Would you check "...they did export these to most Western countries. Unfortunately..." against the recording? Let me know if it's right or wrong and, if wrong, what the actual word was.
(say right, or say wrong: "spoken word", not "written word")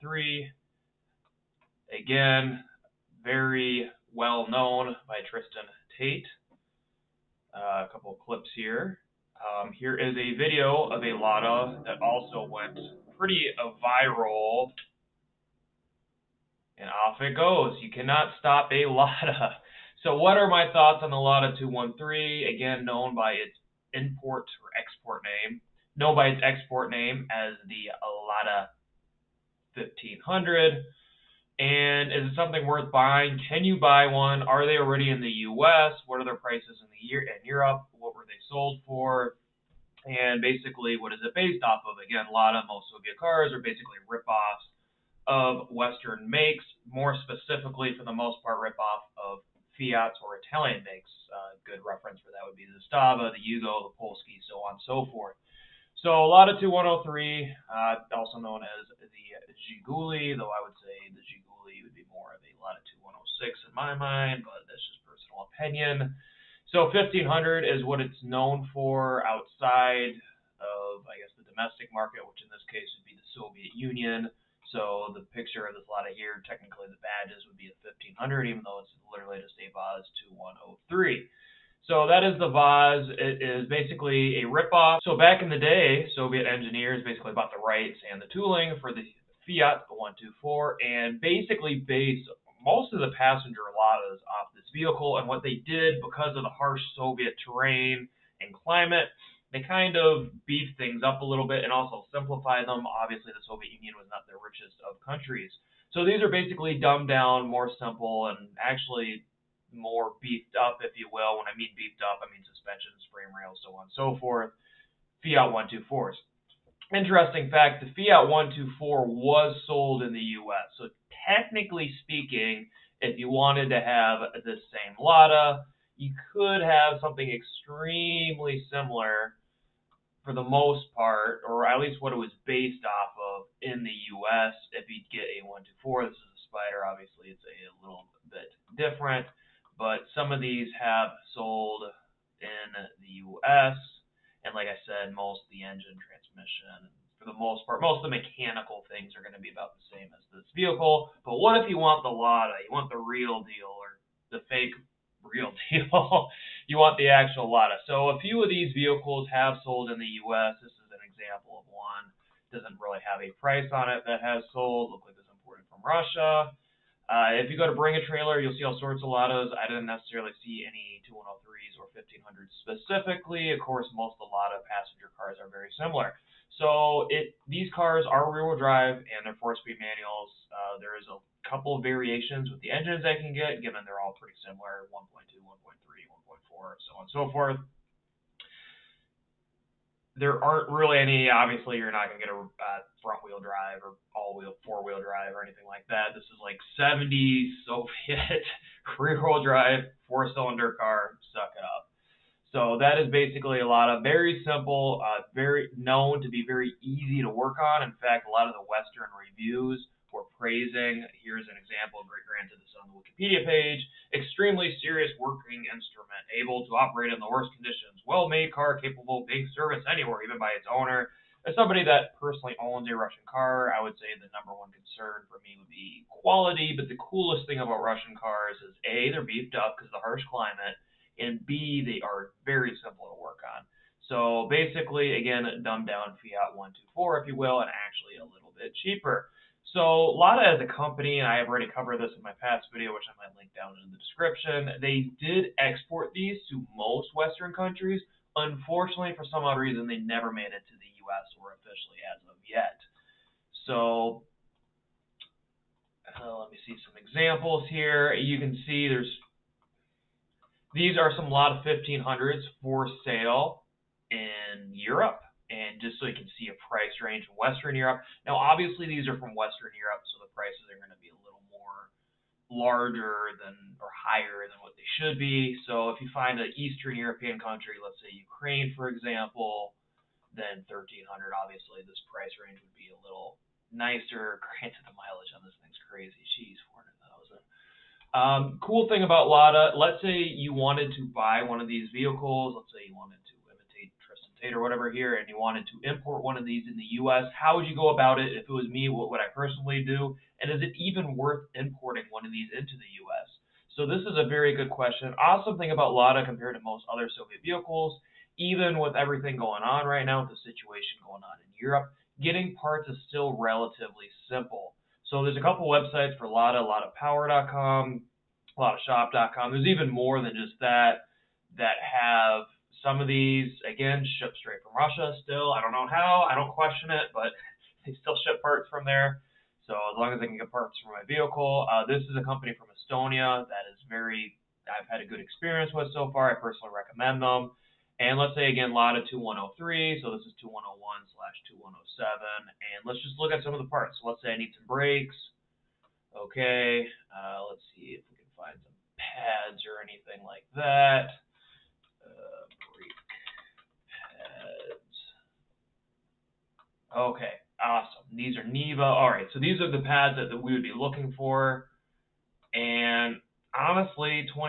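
right.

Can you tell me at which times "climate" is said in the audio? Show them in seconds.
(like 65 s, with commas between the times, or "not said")
98 s, 230 s.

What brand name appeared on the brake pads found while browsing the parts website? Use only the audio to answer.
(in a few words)
Neva.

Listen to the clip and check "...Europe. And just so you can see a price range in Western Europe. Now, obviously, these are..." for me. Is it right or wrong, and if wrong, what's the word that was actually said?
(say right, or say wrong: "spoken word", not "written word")
right.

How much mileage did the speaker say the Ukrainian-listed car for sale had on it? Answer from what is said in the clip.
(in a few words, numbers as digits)
400,000.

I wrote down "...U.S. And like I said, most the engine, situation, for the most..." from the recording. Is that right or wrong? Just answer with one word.
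wrong.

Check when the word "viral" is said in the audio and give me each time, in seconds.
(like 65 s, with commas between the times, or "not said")
13 s.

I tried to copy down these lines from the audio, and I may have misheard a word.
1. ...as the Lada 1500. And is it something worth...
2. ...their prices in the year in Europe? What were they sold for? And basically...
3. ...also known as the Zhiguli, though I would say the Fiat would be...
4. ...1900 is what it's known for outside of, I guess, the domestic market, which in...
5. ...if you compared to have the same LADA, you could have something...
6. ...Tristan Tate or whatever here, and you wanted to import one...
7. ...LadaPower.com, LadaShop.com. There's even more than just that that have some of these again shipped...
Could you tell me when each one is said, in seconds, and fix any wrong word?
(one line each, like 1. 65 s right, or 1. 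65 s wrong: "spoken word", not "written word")
1. 27 s right
2. 36 s right
3. 58 s wrong: "Zhiguli", not "Fiat"
4. 66 s wrong: "1500", not "1900"
5. 122 s wrong: "wanted", not "compared"
6. 294 s right
7. 316 s right.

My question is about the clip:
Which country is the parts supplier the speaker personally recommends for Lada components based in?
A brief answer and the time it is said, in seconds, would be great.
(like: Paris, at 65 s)
Estonia, at 332 s.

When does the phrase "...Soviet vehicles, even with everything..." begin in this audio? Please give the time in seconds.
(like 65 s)
307 s.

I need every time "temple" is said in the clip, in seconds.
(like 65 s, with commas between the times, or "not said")
not said.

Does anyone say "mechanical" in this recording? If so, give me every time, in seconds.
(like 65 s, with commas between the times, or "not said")
148 s.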